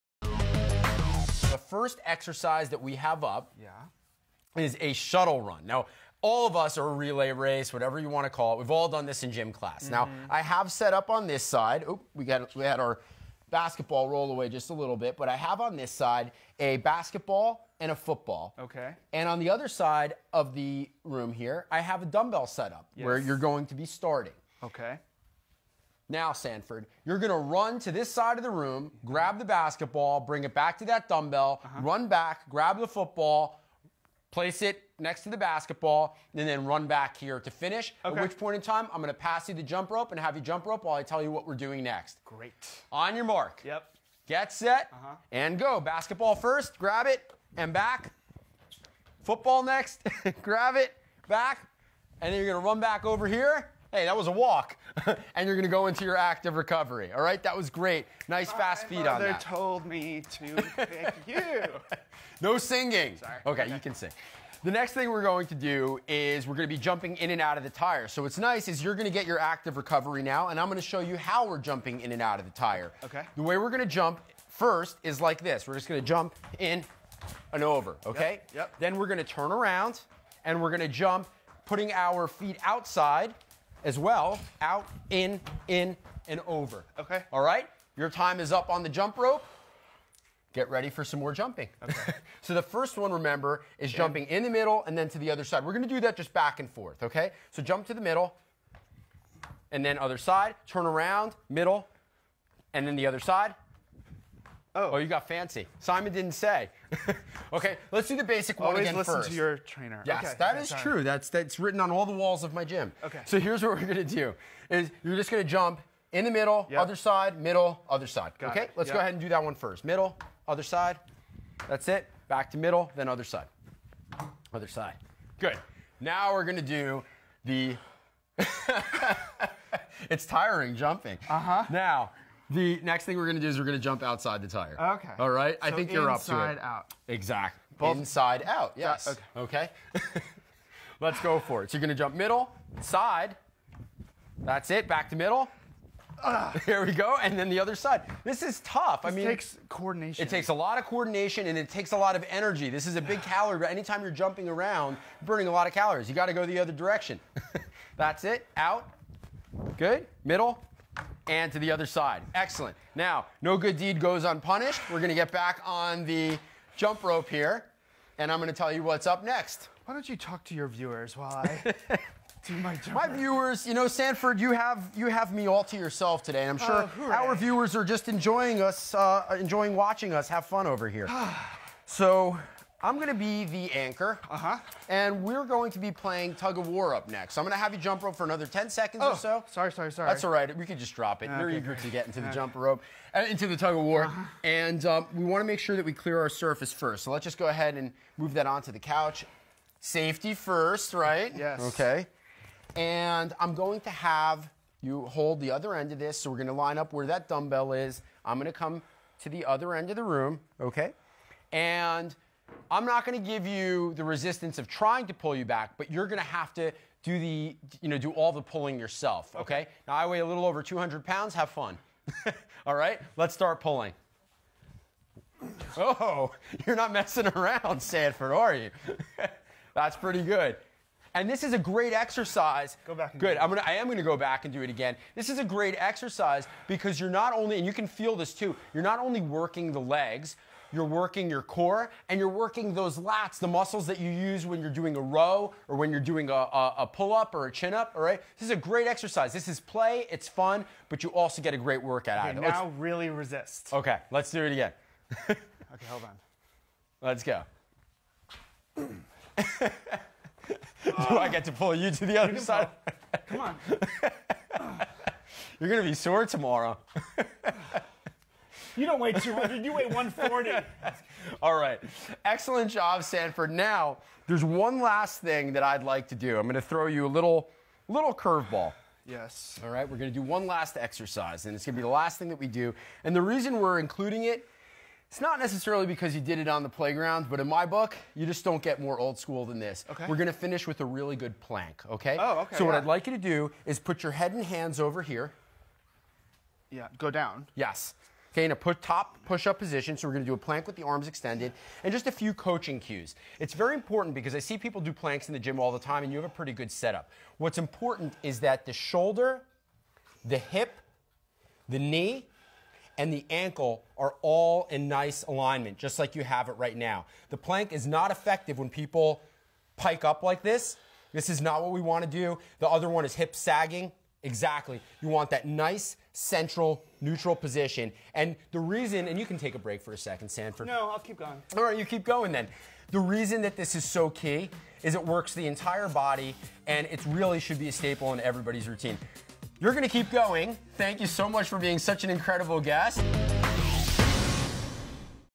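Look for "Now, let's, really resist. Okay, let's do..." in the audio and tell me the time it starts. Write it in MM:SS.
04:12.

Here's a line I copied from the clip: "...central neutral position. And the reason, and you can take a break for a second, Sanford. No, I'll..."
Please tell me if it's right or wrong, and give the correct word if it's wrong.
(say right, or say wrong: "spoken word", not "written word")
right.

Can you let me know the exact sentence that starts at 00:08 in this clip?
We've all done this in gym class.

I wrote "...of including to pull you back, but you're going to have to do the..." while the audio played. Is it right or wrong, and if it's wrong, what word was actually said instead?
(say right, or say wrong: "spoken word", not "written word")
wrong: "trying", not "including".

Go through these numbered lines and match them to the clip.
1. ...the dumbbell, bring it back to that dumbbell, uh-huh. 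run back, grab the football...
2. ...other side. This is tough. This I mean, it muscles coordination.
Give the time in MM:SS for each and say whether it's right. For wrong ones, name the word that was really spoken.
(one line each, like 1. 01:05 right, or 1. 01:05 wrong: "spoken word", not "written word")
1. 00:29 wrong: "basketball", not "dumbbell"
2. 02:27 wrong: "takes", not "muscles".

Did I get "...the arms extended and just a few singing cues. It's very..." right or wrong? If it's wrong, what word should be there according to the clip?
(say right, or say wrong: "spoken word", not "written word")
wrong: "coaching", not "singing".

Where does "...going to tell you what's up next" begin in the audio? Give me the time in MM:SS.
02:48.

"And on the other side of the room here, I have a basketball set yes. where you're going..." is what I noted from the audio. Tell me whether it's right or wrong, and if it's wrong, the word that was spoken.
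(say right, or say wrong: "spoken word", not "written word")
wrong: "dumbbell", not "basketball".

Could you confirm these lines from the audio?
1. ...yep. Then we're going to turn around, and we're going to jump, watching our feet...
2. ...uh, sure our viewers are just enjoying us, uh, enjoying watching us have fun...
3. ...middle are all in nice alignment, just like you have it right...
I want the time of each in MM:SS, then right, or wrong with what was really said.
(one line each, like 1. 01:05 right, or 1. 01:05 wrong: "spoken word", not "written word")
1. 01:18 wrong: "putting", not "watching"
2. 02:56 right
3. 05:13 wrong: "ankle", not "middle".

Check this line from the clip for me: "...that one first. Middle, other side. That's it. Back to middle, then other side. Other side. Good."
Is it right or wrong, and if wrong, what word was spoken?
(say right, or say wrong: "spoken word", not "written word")
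right.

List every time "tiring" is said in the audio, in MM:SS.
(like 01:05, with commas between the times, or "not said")
02:10.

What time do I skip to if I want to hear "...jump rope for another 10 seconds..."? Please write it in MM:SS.
03:07.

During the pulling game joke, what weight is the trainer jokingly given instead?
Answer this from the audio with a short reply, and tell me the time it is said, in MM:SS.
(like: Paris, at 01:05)
140, at 04:29.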